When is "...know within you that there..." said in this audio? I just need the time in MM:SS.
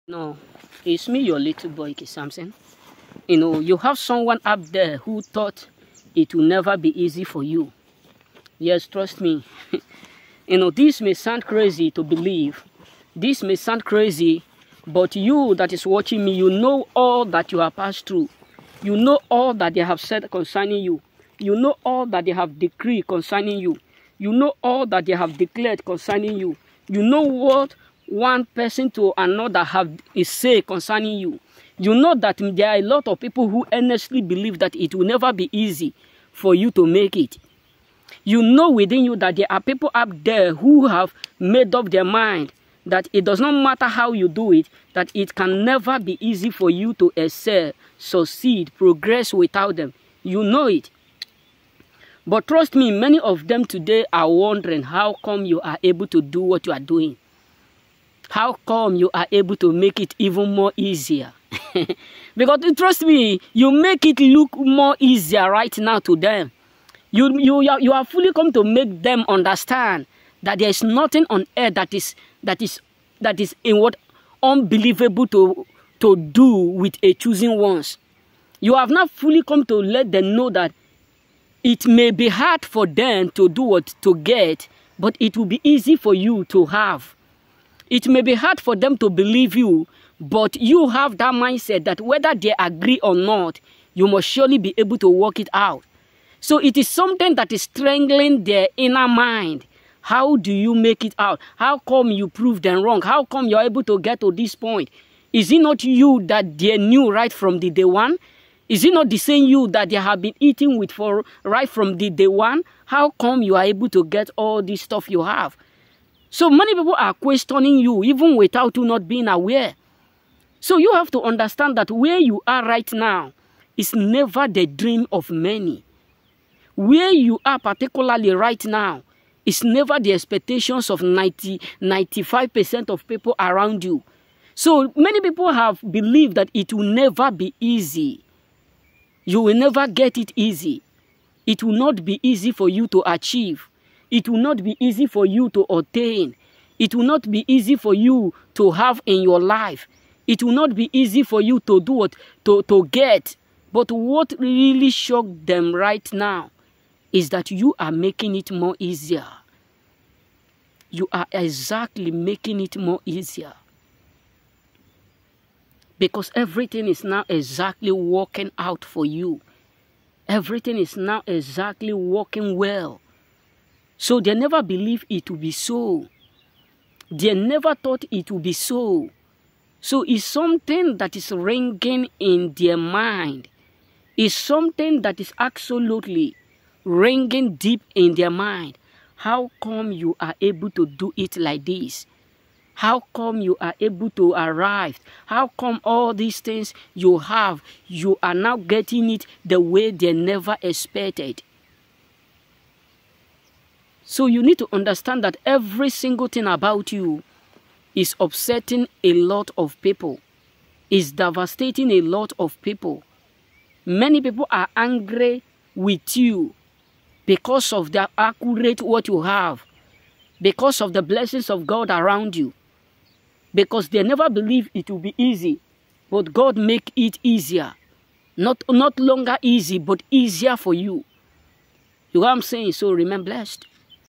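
00:38.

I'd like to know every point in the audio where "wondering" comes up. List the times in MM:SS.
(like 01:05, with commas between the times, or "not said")
00:54.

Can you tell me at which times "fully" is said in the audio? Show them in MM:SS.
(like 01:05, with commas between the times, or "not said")
01:08, 01:19.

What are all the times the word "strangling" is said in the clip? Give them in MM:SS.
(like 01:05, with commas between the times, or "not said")
01:37.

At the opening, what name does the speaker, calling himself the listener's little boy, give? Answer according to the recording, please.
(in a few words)
Samson.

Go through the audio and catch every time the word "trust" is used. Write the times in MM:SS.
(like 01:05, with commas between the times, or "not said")
00:08, 00:52, 01:02.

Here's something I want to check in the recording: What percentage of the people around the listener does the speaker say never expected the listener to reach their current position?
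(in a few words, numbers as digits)
95%.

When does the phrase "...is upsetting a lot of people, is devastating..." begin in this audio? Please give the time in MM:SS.
03:27.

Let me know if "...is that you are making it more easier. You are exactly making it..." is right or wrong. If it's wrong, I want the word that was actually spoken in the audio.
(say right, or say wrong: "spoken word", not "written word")
right.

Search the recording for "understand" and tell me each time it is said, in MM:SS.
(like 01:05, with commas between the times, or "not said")
01:09, 02:01, 03:24.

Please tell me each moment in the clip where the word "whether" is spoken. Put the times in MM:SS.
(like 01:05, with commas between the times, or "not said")
01:31.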